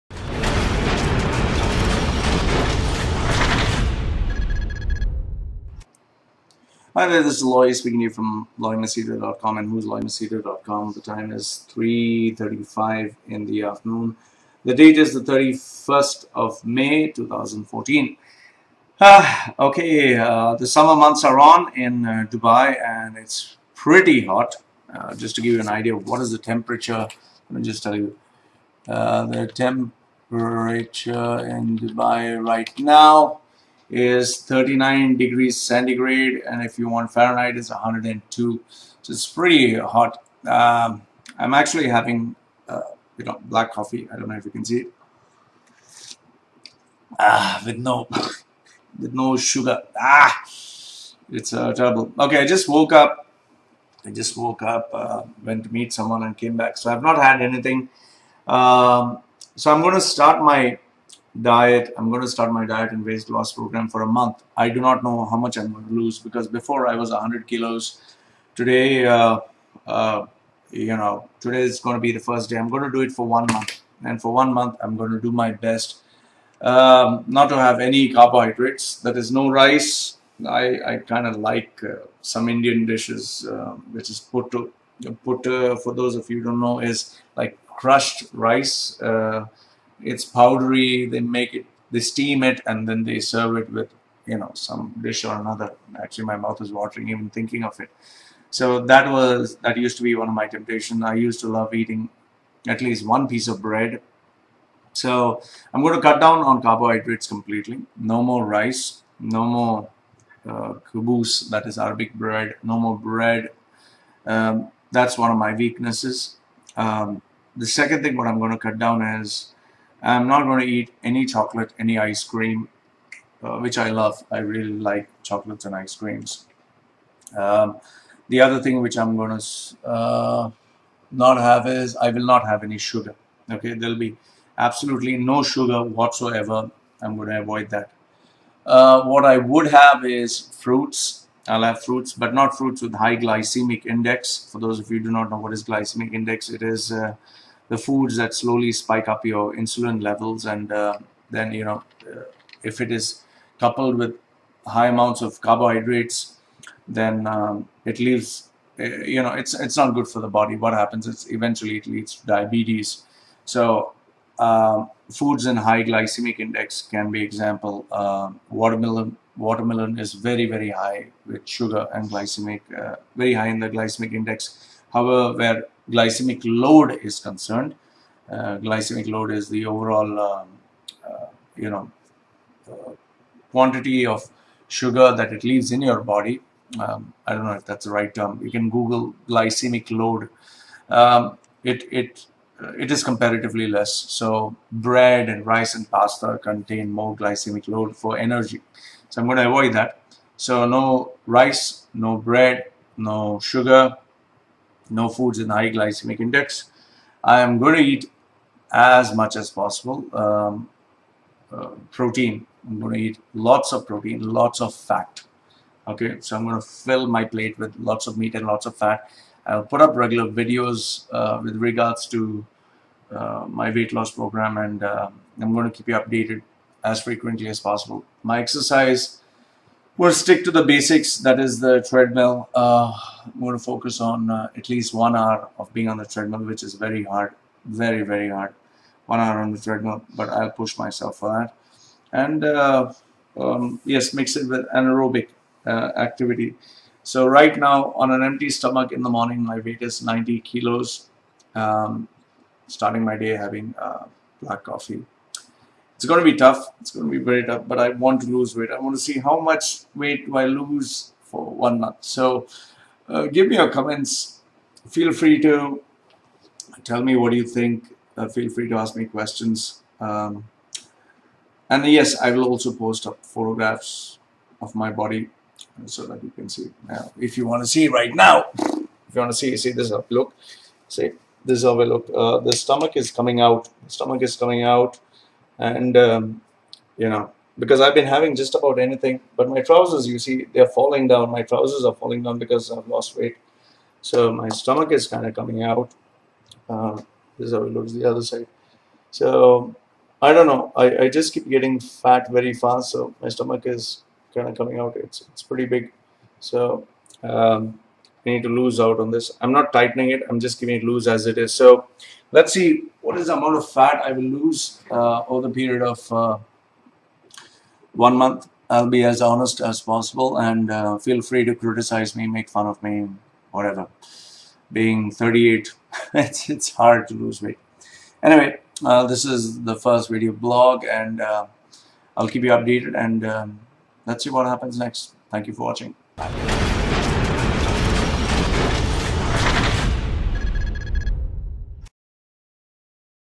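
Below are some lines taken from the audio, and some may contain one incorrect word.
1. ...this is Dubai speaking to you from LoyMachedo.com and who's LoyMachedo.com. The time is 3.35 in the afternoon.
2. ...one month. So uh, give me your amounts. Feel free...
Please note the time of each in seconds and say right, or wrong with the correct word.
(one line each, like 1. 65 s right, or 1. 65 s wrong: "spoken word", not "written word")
1. 7 s wrong: "Loy", not "Dubai"
2. 261 s wrong: "comments", not "amounts".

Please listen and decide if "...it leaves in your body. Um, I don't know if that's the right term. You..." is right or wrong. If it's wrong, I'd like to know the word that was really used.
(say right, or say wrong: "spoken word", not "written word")
right.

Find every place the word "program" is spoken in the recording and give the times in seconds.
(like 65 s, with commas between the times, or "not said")
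63 s, 224 s.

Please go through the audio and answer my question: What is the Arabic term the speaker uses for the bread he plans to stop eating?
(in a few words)
Kubus.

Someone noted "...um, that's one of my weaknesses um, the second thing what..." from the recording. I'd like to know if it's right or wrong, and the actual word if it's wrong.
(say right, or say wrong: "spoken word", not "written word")
right.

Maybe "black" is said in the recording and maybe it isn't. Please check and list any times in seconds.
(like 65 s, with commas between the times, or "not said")
43 s, 254 s.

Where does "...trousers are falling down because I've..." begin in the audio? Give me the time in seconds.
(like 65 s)
291 s.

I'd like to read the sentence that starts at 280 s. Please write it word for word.
Look, see this is how I look.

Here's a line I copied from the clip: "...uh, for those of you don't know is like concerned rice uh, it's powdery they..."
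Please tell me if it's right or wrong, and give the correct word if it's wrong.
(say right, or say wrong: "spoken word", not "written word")
wrong: "crushed", not "concerned".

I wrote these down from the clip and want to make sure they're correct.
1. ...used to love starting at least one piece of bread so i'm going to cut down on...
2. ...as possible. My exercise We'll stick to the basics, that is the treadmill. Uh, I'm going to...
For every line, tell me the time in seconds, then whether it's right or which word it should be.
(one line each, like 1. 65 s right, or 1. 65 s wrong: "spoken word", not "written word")
1. 101 s wrong: "eating", not "starting"
2. 227 s right.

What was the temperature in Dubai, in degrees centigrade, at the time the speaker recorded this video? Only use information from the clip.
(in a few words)
39.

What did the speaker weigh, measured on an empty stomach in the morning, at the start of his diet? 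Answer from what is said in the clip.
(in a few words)
90 kilos.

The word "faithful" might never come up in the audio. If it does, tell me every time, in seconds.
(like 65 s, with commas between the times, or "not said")
not said.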